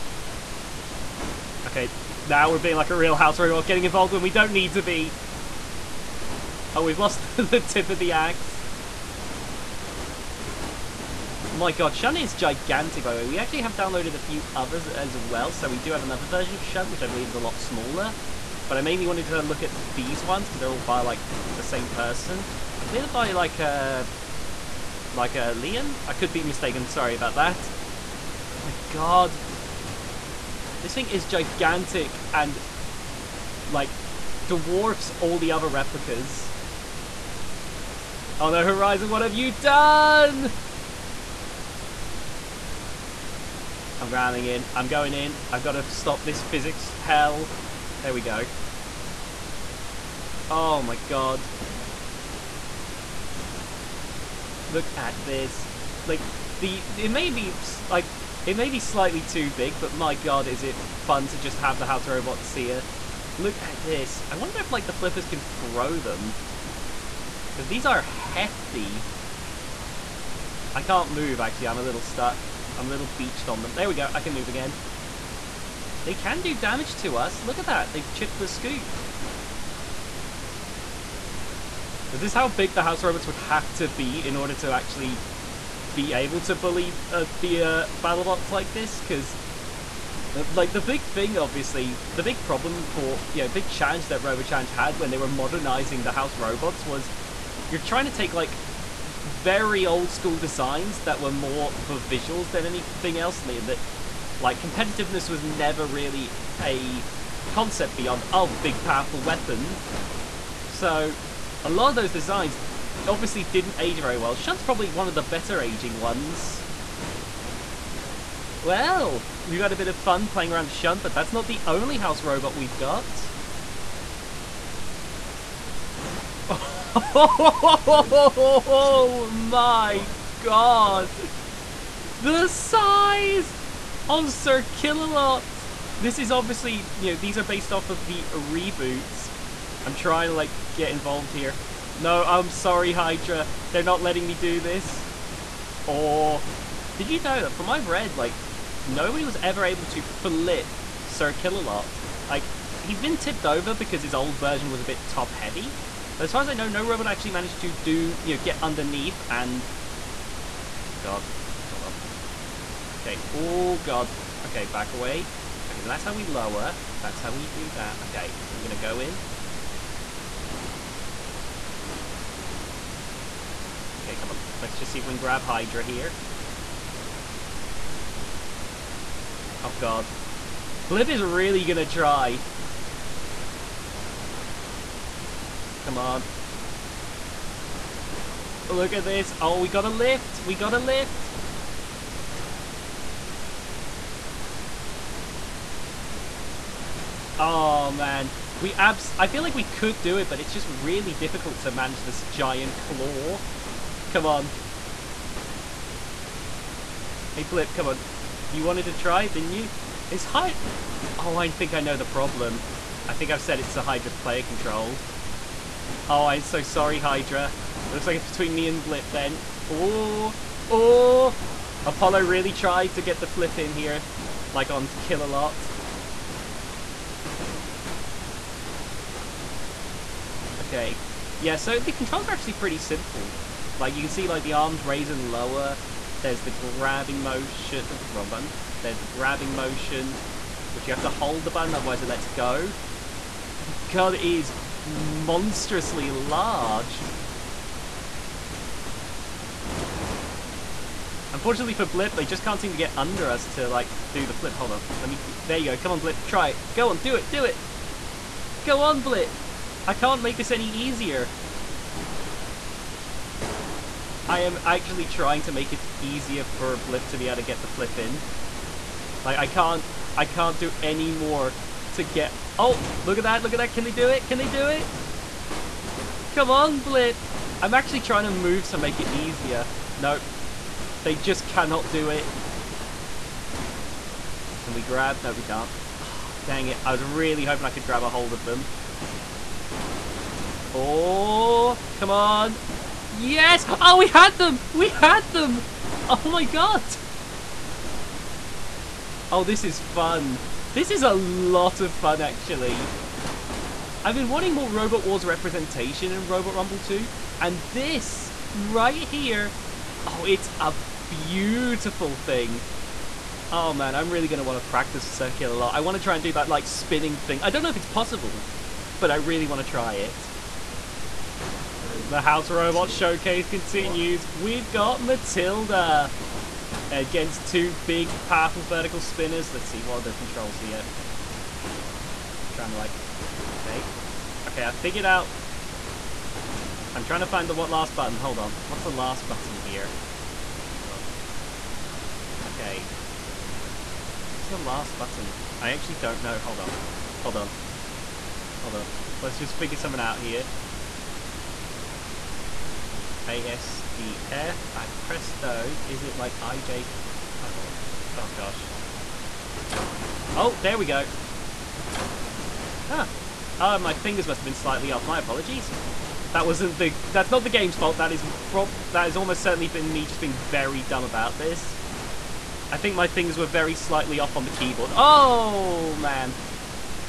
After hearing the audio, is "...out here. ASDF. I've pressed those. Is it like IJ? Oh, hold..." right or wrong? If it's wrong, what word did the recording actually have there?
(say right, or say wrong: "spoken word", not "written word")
right.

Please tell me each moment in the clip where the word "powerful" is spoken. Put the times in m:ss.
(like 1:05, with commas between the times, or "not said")
1:48, 5:28.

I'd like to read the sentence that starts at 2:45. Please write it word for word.
Okay, so that's how we lower.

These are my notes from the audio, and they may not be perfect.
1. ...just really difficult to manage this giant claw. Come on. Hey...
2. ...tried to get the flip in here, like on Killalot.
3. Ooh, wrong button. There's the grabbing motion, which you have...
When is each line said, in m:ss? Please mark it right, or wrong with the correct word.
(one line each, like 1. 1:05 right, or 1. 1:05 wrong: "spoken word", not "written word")
1. 3:20 right
2. 3:42 right
3. 3:57 right.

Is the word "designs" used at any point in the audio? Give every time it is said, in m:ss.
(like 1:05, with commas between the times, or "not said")
1:40, 1:52.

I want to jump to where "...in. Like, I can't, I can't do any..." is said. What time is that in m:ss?
4:27.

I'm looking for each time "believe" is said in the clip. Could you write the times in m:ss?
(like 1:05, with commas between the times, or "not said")
0:17, 0:22.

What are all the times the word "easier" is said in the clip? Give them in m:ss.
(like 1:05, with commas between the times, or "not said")
4:20, 4:26, 4:39.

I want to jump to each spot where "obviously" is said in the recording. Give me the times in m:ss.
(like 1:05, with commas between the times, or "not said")
1:31, 1:53, 2:16.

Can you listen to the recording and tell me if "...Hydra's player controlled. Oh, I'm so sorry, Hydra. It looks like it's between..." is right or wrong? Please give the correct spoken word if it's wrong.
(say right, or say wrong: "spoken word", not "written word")
right.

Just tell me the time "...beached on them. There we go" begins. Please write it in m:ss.
1:13.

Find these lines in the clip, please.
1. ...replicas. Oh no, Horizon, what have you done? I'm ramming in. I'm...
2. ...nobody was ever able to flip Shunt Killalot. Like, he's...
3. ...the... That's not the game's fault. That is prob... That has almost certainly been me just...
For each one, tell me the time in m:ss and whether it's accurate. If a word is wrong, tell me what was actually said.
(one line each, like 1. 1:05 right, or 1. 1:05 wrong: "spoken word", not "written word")
1. 0:35 right
2. 2:28 wrong: "Sir", not "Shunt"
3. 6:06 right.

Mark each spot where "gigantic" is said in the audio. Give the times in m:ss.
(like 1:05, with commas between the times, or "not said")
0:12, 0:31.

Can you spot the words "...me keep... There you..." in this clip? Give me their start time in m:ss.
4:15.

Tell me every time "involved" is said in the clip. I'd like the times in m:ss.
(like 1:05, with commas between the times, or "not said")
0:03, 2:20.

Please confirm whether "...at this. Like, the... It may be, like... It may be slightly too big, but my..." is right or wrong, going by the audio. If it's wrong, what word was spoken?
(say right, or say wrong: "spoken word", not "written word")
right.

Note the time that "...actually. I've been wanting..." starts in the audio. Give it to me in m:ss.
5:02.